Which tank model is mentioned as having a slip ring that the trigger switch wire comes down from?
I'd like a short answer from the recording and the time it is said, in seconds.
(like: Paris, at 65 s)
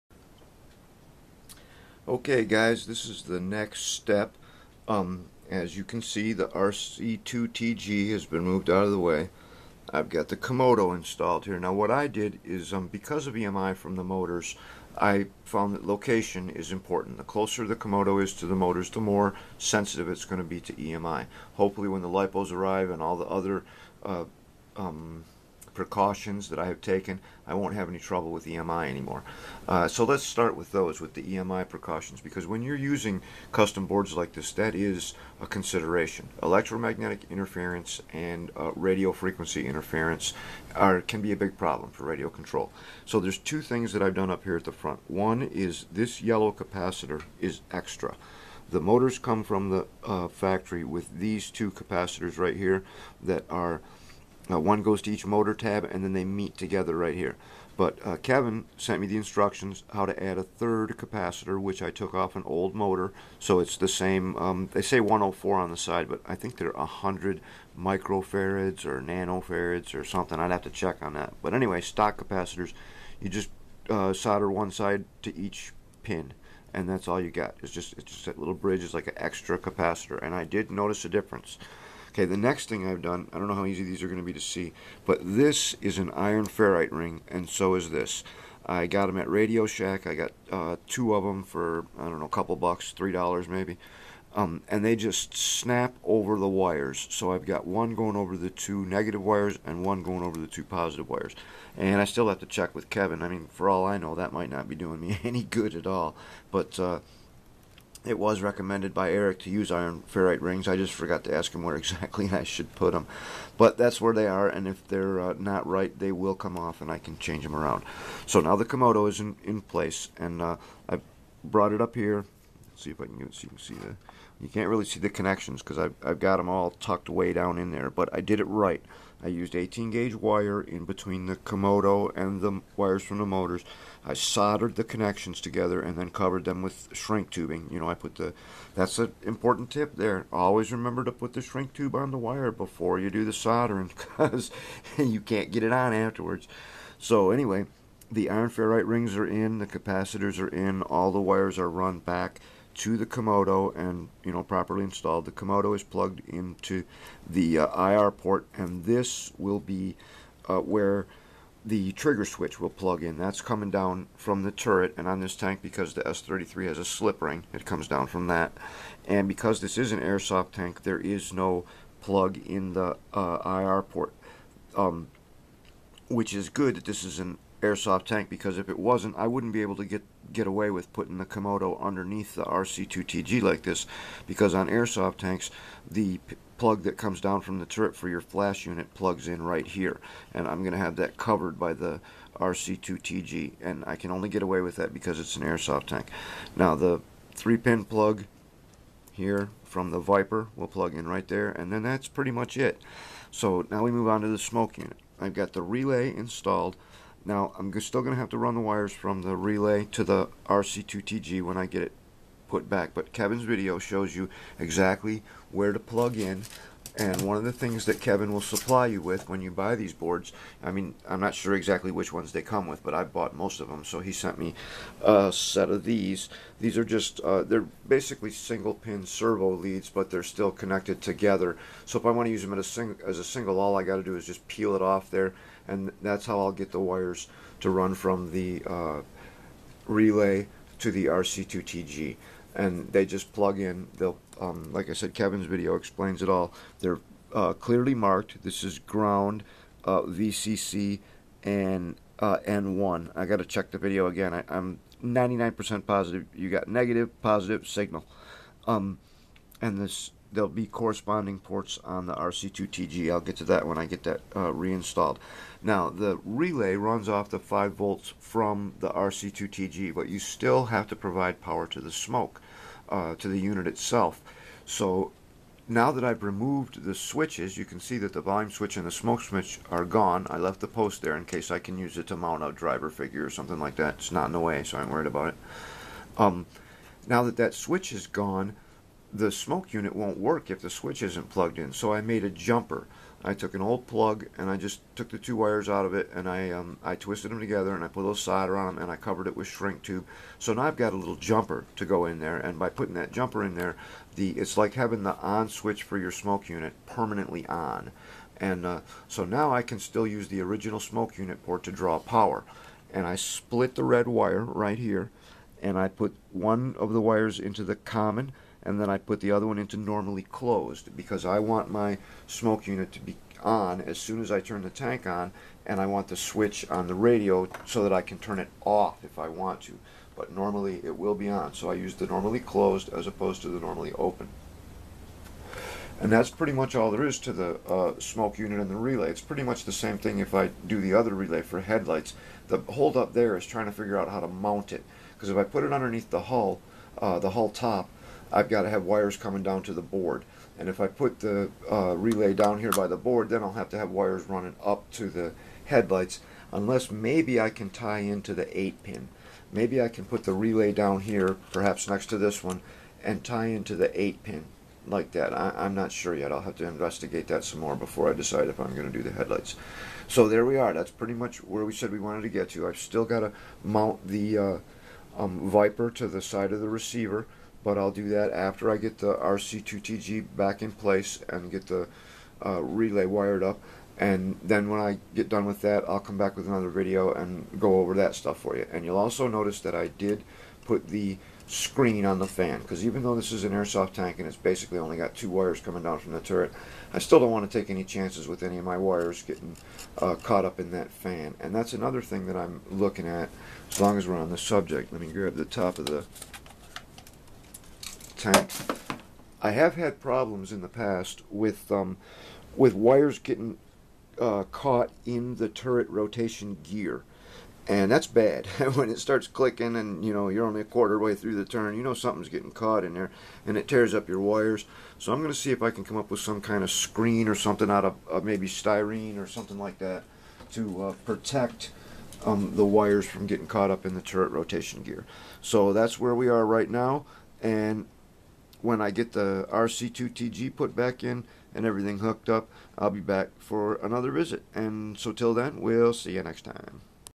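S-33, at 166 s.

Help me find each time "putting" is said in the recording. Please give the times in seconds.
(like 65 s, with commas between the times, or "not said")
180 s, 302 s.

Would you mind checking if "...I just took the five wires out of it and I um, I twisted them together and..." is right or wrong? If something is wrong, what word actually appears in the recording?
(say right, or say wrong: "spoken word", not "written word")
wrong: "two", not "five".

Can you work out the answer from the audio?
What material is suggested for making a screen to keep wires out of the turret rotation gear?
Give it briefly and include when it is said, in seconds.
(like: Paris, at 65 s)
Styrene, at 428 s.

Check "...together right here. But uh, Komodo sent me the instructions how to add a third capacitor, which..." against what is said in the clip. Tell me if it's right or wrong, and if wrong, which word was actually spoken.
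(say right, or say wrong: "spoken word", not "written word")
wrong: "Kevin", not "Komodo".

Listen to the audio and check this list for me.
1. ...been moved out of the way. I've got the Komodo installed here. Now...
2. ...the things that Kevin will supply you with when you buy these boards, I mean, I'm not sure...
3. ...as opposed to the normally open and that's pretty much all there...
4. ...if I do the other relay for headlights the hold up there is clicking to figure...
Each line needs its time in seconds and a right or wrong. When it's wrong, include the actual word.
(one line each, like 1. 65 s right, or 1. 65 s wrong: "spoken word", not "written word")
1. 8 s right
2. 217 s right
3. 332 s right
4. 340 s wrong: "trying", not "clicking".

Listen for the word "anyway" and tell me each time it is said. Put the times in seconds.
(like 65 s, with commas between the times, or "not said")
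71 s, 147 s.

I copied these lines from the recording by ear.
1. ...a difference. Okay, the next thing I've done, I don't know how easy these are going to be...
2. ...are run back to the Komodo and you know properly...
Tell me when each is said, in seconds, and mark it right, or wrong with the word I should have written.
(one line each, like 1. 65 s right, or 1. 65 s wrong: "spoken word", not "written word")
1. 81 s right
2. 151 s right.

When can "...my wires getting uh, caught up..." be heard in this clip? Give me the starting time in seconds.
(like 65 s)
398 s.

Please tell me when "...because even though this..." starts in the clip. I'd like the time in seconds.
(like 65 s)
392 s.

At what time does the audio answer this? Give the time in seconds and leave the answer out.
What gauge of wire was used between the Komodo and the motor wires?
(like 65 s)
129 s.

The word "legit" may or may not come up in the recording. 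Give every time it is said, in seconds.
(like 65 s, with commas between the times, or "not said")
not said.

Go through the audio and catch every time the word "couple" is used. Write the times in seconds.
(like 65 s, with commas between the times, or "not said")
92 s.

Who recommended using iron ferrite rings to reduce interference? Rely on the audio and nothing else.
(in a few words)
Eric.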